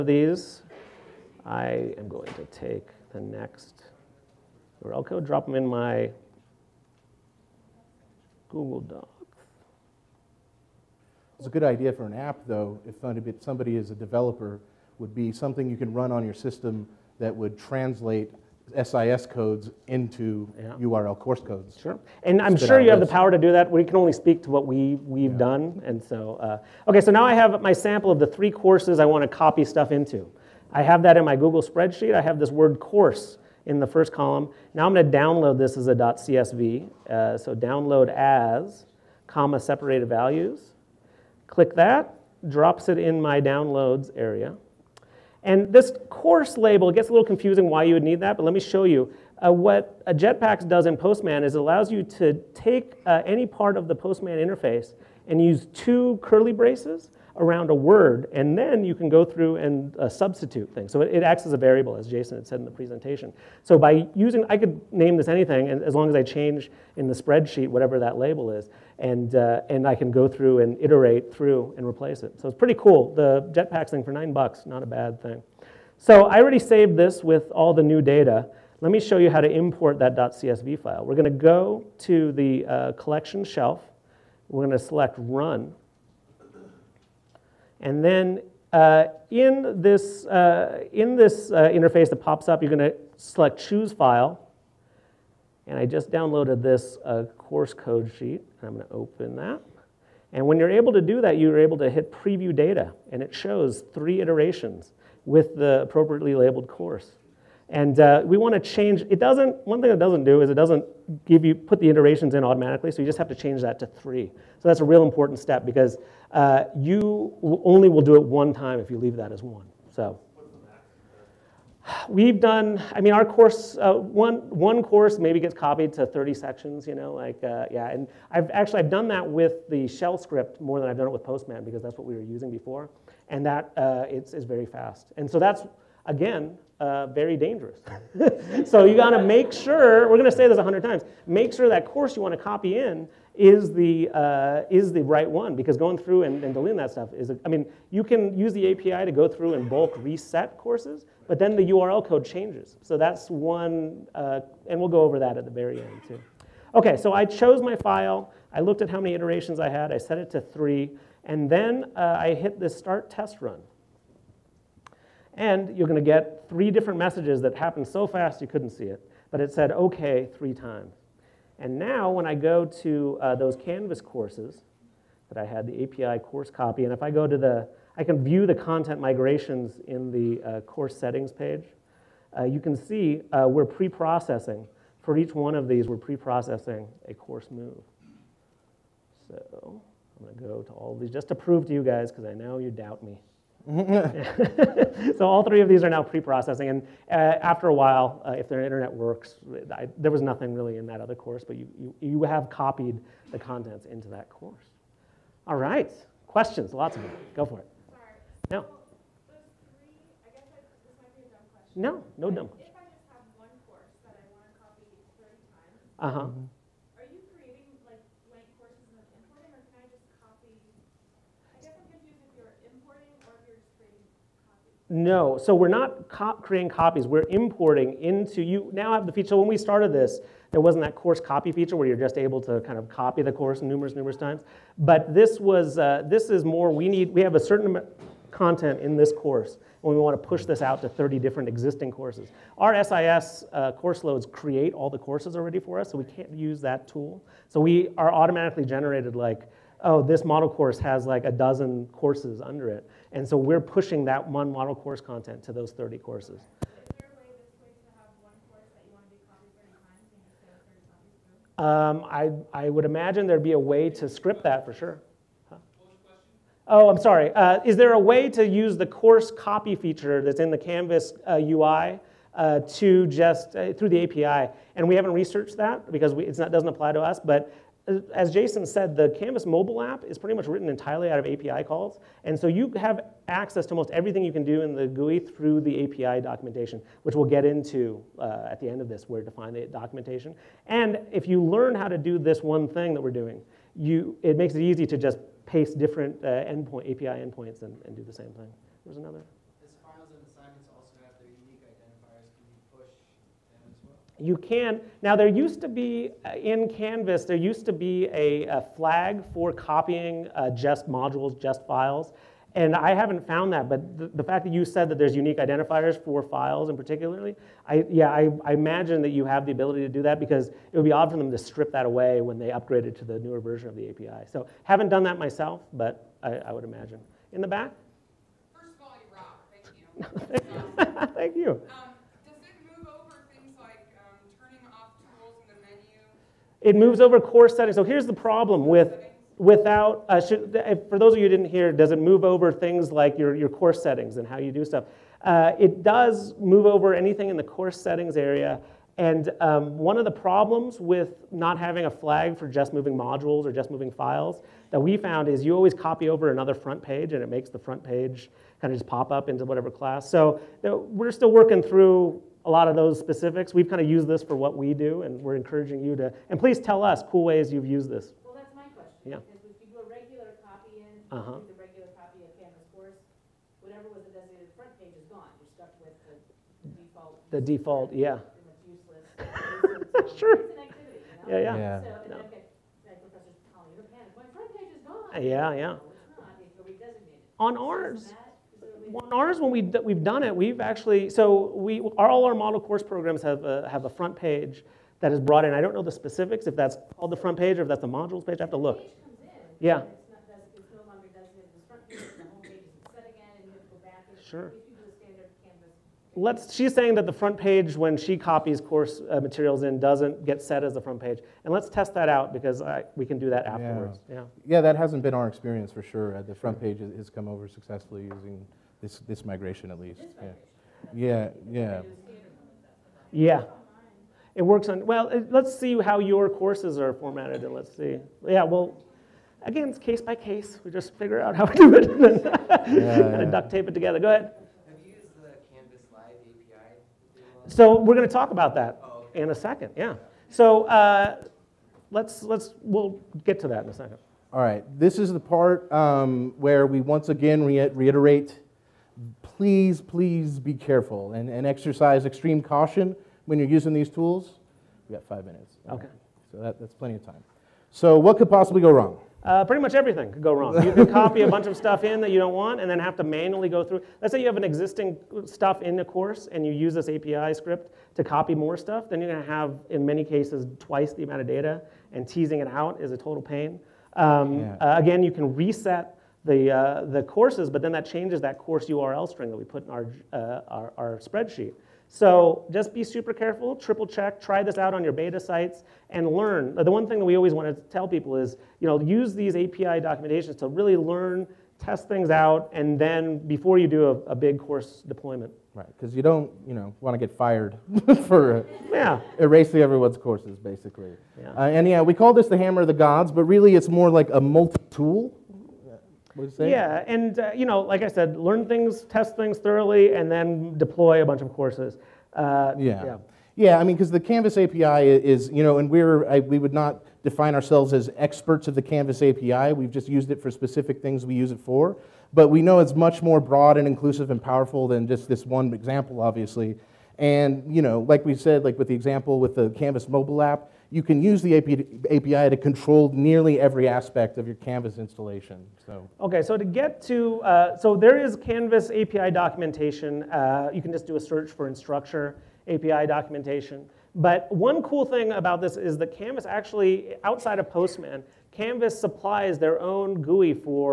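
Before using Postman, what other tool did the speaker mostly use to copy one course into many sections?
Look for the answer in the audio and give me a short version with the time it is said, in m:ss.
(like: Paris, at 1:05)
shell script, at 2:09.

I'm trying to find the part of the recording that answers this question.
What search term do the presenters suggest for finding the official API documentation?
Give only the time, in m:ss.
9:01.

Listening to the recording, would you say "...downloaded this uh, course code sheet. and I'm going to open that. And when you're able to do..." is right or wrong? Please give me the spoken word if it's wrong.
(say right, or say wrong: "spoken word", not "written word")
right.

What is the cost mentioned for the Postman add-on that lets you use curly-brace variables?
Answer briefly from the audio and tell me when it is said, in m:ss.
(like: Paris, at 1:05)
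$9, at 1:14.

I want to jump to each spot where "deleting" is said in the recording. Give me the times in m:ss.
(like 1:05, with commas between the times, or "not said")
2:26.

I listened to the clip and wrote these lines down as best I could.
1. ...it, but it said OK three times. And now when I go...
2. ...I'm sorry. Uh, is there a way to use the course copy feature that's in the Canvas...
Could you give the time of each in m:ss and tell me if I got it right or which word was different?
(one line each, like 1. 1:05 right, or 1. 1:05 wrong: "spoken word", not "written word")
1. 2:48 right
2. 4:26 right.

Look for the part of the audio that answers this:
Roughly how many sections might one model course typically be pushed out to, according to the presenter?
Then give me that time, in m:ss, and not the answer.
2:06.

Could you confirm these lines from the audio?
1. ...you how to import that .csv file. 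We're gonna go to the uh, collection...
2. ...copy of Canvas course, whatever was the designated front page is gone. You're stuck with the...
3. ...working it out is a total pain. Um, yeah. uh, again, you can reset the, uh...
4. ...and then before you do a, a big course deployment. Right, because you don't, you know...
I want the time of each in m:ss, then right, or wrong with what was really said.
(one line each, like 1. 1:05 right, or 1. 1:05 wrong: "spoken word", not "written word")
1. 1:19 right
2. 6:11 right
3. 7:52 wrong: "teasing", not "working"
4. 8:12 right.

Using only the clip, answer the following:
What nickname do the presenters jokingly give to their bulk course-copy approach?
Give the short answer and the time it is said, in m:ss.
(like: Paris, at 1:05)
hammer of the gods, at 8:22.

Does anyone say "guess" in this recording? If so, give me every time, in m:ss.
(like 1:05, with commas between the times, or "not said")
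3:30.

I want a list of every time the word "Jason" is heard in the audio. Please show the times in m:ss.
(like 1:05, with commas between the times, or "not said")
1:02, 4:38.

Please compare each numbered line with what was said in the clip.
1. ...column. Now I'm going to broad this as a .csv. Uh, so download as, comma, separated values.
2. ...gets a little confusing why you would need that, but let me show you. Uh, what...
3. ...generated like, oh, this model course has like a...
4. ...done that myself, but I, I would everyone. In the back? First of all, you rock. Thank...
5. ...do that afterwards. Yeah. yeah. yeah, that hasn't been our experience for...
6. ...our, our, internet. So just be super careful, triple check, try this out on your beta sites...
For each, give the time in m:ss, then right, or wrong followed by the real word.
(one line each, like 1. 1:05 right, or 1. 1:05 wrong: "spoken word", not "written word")
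1. 0:34 wrong: "download", not "broad"
2. 0:46 right
3. 4:08 right
4. 5:24 wrong: "imagine", not "everyone"
5. 6:53 right
6. 8:00 wrong: "spreadsheet", not "internet".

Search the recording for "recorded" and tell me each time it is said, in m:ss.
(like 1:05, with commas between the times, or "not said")
not said.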